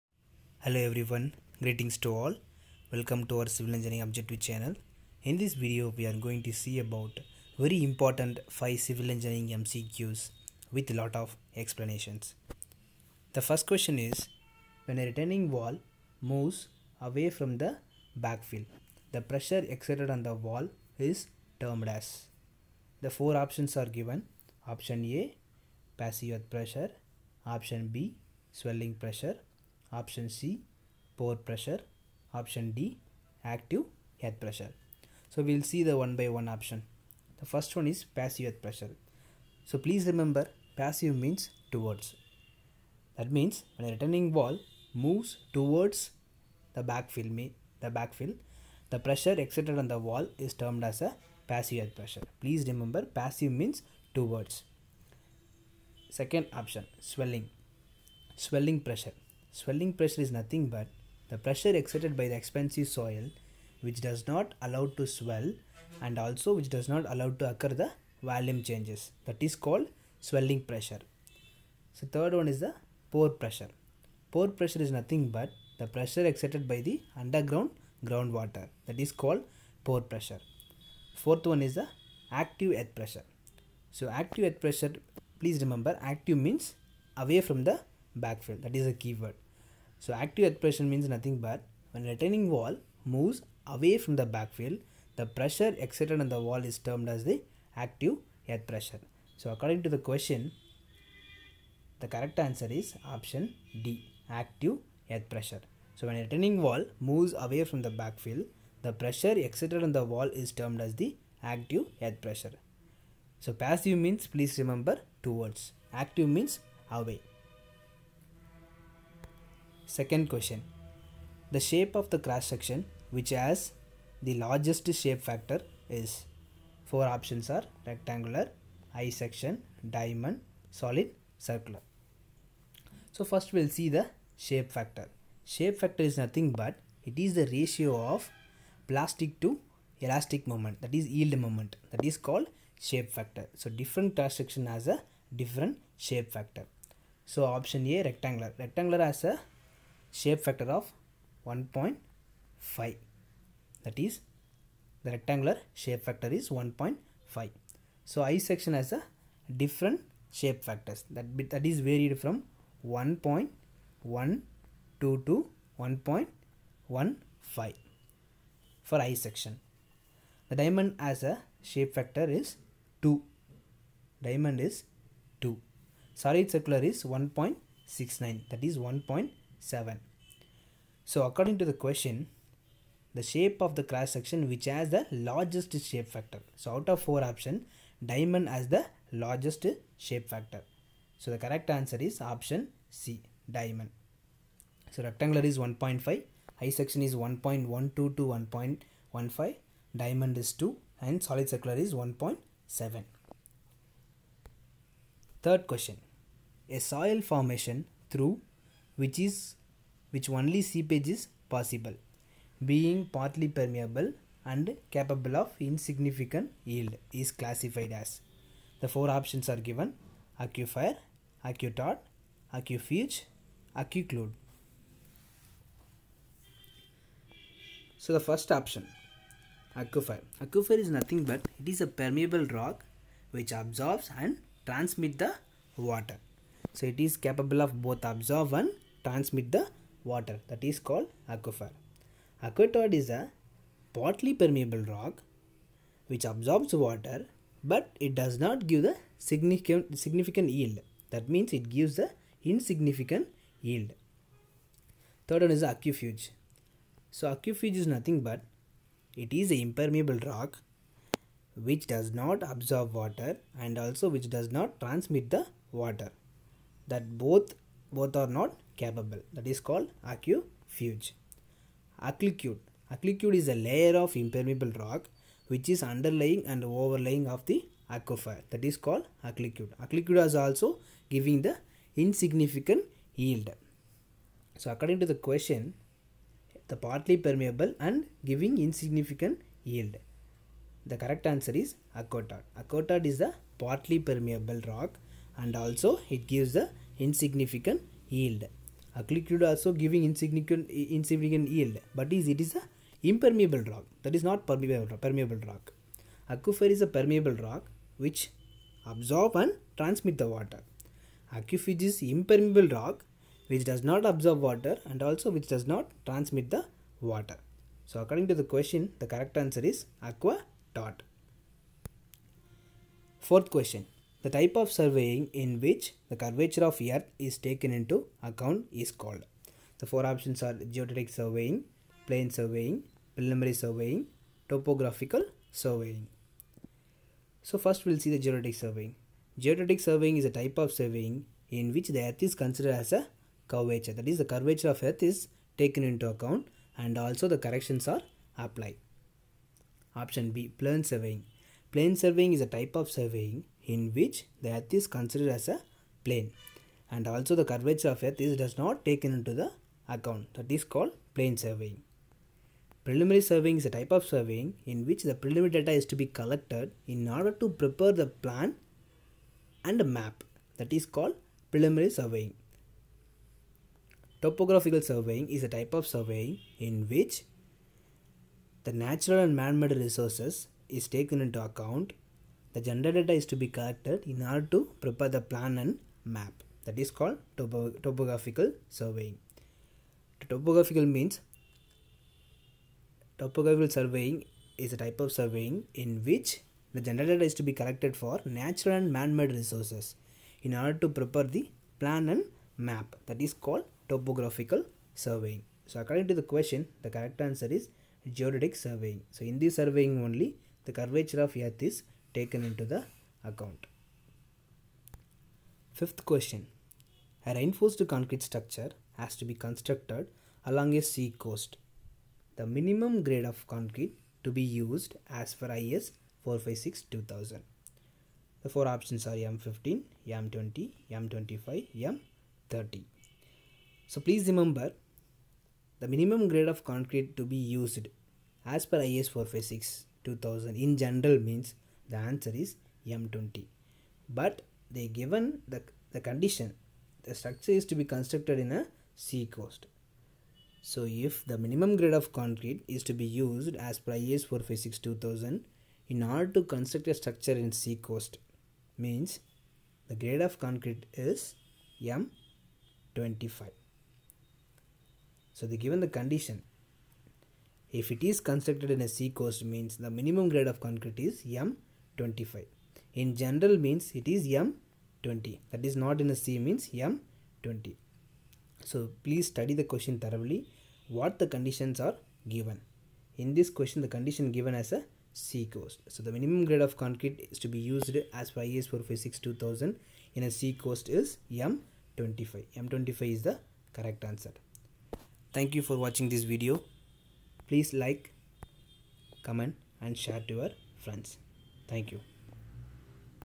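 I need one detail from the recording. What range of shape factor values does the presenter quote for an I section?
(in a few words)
1.12 to 1.15.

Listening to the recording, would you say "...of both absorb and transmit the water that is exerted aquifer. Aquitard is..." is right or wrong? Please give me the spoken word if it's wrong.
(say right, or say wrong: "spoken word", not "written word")
wrong: "called", not "exerted".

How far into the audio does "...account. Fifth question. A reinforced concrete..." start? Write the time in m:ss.
6:53.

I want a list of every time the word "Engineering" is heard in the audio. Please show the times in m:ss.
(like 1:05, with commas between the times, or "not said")
0:03, 0:09.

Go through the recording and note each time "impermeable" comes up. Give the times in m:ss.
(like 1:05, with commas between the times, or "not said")
4:19, 4:34, 5:03, 5:12.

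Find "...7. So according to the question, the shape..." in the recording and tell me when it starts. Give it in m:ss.
2:59.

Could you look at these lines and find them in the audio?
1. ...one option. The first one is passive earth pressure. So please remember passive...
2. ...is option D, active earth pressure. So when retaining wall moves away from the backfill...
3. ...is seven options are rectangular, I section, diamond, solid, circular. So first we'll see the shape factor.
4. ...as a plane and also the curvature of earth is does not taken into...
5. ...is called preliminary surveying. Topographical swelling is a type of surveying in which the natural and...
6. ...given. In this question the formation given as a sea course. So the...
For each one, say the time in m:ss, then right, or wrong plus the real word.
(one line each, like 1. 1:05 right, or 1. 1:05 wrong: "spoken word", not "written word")
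1. 0:36 right
2. 1:42 right
3. 2:05 wrong: "four", not "seven"
4. 5:55 right
5. 6:10 wrong: "surveying", not "swelling"
6. 8:02 wrong: "condition", not "formation".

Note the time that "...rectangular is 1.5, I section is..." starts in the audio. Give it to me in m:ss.
3:15.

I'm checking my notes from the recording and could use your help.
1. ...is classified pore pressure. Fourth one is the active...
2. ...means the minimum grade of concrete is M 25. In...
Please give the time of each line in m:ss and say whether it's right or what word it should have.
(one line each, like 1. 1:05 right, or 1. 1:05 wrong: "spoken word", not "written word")
1. 1:19 wrong: "called", not "classified"
2. 7:49 right.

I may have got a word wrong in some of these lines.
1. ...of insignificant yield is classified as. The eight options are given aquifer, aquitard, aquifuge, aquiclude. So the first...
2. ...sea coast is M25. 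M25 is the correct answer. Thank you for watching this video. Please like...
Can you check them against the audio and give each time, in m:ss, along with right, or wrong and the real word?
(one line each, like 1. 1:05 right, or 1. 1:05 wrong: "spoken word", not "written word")
1. 3:35 wrong: "four", not "eight"
2. 8:10 right.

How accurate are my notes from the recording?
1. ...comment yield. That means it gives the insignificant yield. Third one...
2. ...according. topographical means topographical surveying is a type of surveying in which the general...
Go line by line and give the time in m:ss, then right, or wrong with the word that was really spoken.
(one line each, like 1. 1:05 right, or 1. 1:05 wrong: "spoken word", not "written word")
1. 4:09 wrong: "significant", not "comment"
2. 6:28 wrong: "surveying", not "according".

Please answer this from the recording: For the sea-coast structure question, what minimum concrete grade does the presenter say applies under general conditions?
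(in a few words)
M20.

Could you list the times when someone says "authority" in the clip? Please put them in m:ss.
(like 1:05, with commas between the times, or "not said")
not said.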